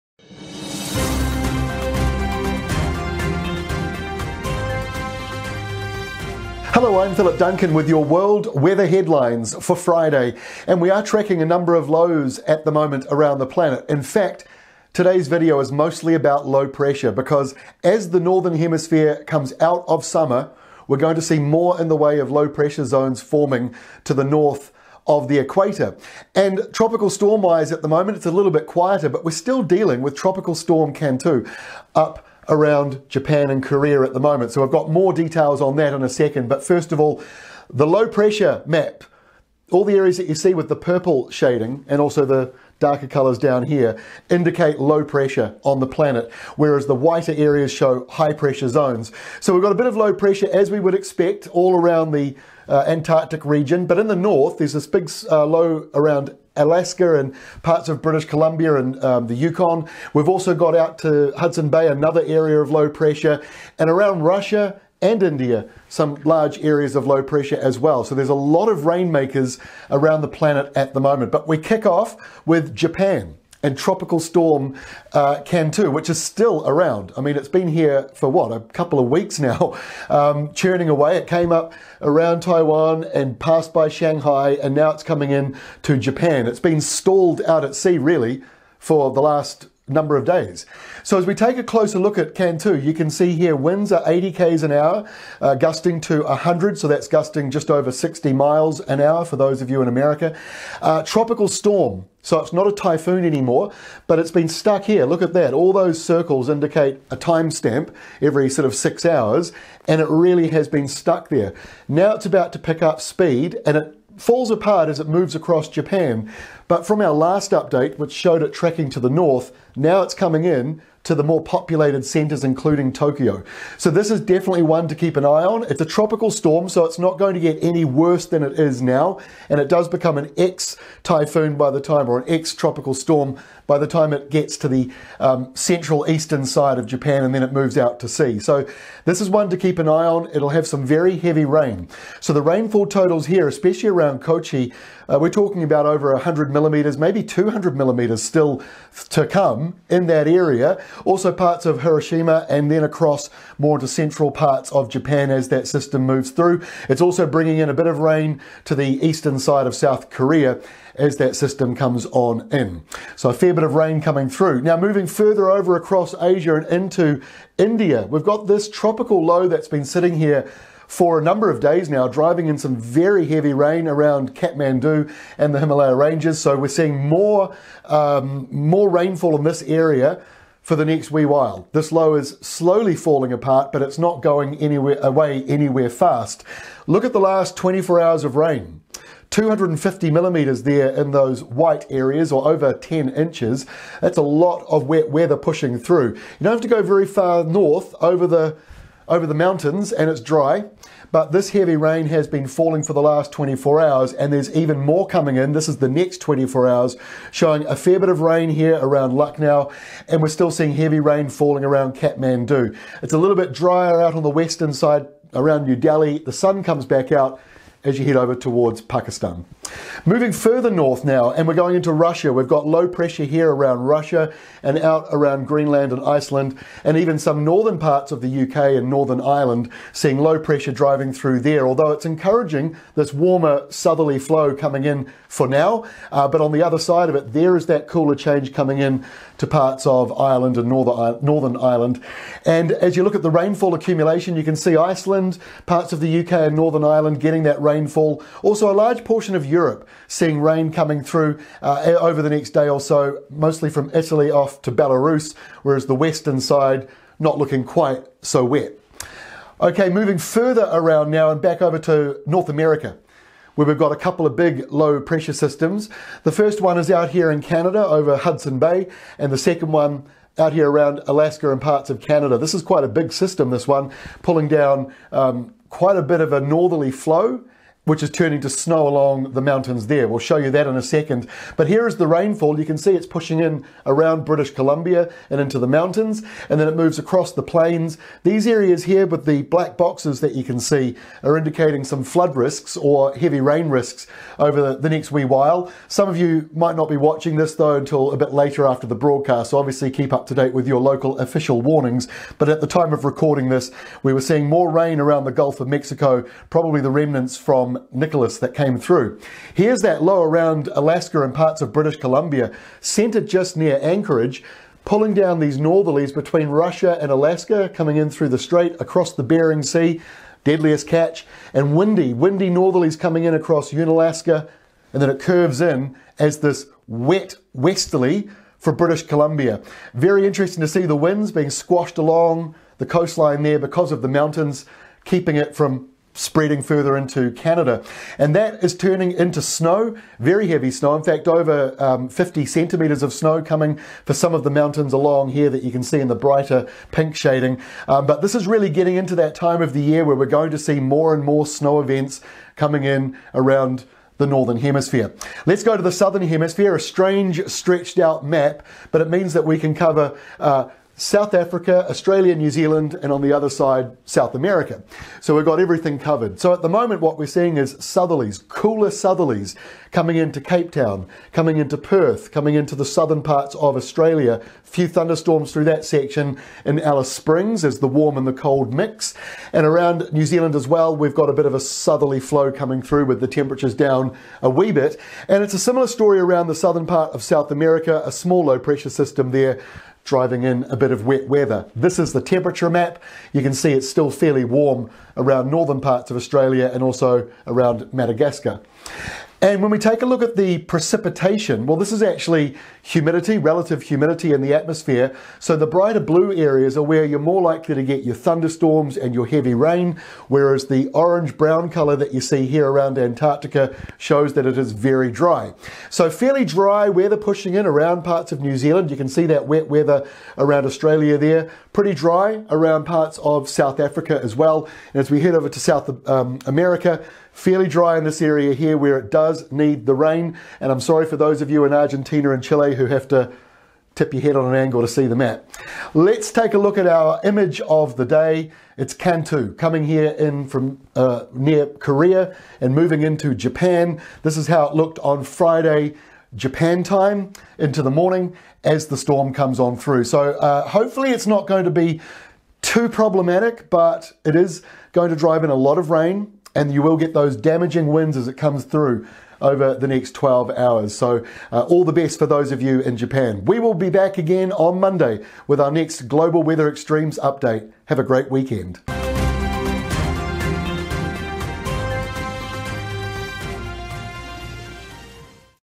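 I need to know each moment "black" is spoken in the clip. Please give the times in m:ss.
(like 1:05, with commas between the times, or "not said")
4:49.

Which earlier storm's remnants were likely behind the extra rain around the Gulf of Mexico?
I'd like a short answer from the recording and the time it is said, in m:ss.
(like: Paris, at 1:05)
Nicholas, at 5:07.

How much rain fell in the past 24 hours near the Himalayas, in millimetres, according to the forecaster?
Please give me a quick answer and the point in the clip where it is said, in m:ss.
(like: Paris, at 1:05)
250 millimetres, at 3:09.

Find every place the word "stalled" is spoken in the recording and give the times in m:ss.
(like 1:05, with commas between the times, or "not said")
1:26.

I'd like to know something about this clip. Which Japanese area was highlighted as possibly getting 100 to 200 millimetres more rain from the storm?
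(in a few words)
Kochi.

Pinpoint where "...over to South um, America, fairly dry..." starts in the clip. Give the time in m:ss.
7:05.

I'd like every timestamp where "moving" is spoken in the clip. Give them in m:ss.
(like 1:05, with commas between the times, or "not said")
2:44, 3:40, 4:19, 7:22.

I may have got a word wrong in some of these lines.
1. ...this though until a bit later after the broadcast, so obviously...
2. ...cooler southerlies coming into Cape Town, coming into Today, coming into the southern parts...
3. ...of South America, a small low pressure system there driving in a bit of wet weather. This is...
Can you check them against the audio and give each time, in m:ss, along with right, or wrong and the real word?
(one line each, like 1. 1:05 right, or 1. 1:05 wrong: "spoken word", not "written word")
1. 4:57 right
2. 6:08 wrong: "Perth", not "Today"
3. 6:27 right.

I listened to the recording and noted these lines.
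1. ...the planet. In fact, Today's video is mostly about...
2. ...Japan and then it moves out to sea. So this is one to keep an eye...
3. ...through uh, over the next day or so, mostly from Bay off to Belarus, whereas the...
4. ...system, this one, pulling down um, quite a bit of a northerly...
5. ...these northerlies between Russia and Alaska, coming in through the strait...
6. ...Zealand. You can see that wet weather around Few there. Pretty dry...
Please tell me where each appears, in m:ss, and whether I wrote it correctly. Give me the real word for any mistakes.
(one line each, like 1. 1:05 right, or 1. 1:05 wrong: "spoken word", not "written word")
1. 0:13 right
2. 2:16 right
3. 4:11 wrong: "Italy", not "Bay"
4. 4:33 right
5. 5:15 right
6. 6:58 wrong: "Australia", not "Few".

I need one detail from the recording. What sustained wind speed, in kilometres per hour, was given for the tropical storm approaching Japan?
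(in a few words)
80 km/h.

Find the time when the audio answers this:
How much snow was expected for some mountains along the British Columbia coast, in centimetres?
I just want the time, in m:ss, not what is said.
5:41.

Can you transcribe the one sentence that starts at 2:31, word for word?
Also parts of Hiroshima and then across more to central parts of Japan as that system moves through.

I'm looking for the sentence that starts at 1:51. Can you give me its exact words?
Now it's about to pick up speed, and it falls apart as it moves across Japan.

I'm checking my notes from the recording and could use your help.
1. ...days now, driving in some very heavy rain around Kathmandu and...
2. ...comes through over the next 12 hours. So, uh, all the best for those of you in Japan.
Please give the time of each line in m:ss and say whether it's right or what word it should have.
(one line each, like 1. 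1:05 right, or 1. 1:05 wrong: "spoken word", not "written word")
1. 2:51 right
2. 7:38 right.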